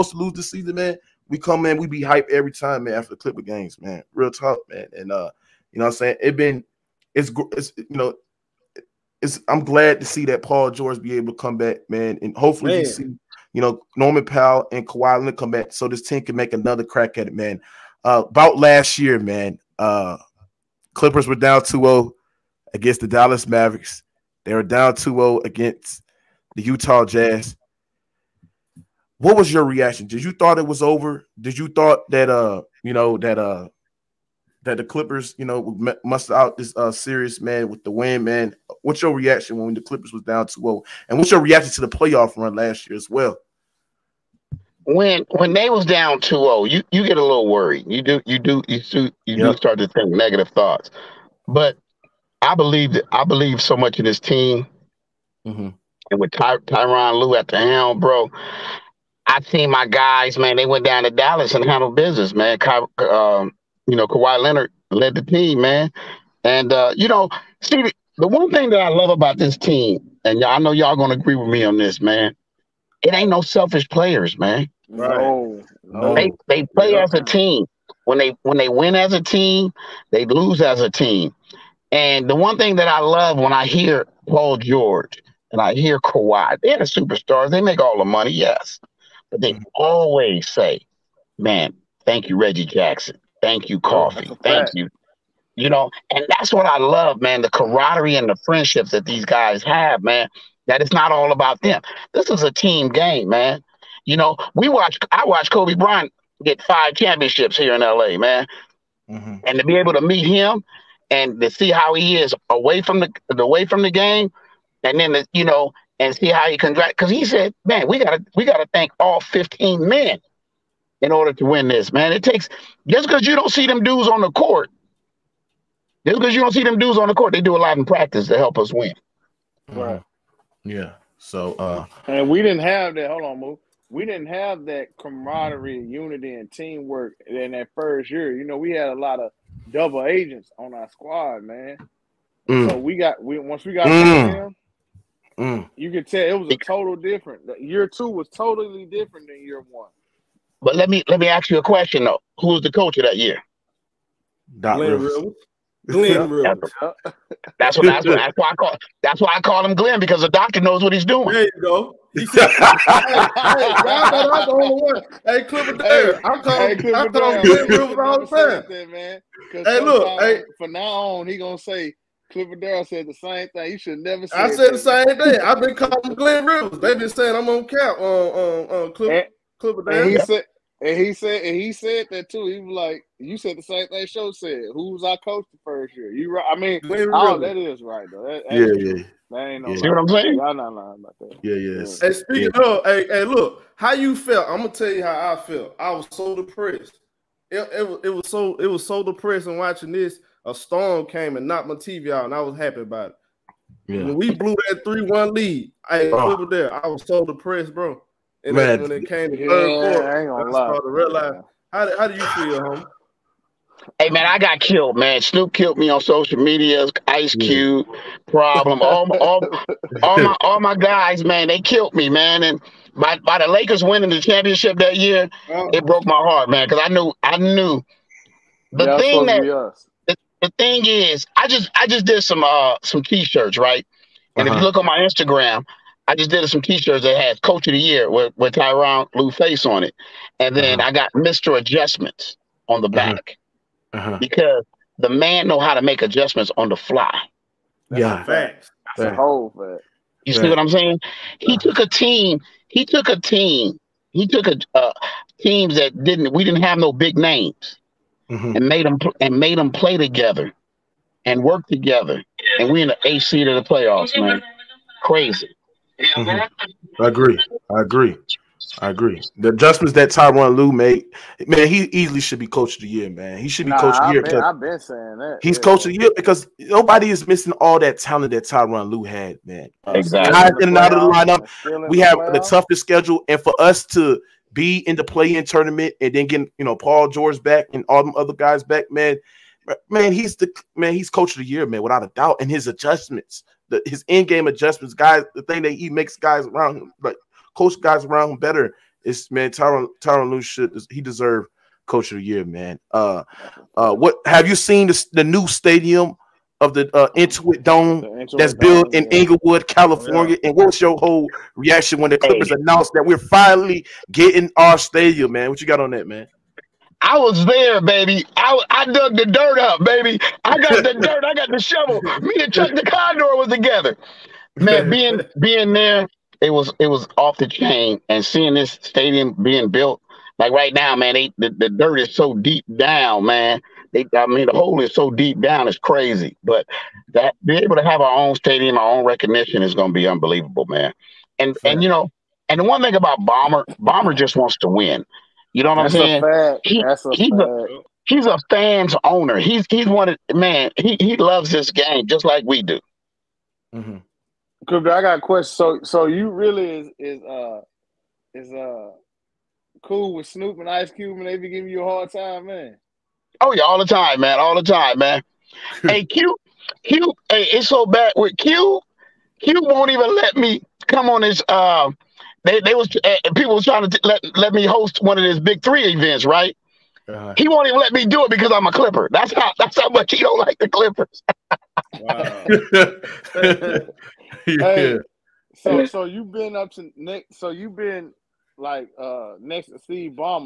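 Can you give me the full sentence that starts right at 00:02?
After the Clipper games, man, real talk, man.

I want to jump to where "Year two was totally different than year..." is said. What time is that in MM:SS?
02:27.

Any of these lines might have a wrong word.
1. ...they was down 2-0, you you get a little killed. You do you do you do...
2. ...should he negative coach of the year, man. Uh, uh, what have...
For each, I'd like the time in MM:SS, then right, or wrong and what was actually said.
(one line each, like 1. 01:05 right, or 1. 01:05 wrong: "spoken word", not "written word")
1. 00:45 wrong: "worried", not "killed"
2. 05:00 wrong: "deserve", not "negative".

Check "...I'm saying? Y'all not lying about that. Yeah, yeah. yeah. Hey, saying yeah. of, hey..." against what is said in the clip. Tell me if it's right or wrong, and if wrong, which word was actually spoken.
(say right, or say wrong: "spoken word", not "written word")
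wrong: "speaking", not "saying".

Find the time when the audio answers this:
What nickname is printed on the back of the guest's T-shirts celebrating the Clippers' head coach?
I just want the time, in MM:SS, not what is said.
04:01.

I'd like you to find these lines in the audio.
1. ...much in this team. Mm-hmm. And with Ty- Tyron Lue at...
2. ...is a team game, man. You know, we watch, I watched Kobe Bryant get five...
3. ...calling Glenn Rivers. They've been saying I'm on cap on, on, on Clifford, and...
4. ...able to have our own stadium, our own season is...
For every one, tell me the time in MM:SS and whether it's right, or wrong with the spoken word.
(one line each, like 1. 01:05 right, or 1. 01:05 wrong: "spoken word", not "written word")
1. 00:53 right
2. 01:42 right
3. 02:55 right
4. 05:37 wrong: "recognition", not "season".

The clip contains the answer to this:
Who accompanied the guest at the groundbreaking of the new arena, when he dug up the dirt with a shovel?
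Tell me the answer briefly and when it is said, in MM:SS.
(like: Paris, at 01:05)
Chuck the Condor, at 05:22.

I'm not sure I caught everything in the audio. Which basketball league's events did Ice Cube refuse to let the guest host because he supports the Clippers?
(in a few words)
Big Three.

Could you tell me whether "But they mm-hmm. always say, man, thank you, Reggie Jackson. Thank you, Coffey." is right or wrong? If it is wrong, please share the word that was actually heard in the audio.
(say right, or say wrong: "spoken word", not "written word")
right.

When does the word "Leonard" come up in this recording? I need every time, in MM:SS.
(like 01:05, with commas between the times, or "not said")
00:15, 01:04.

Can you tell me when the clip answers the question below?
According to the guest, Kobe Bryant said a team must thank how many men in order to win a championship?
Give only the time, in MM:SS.
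01:59.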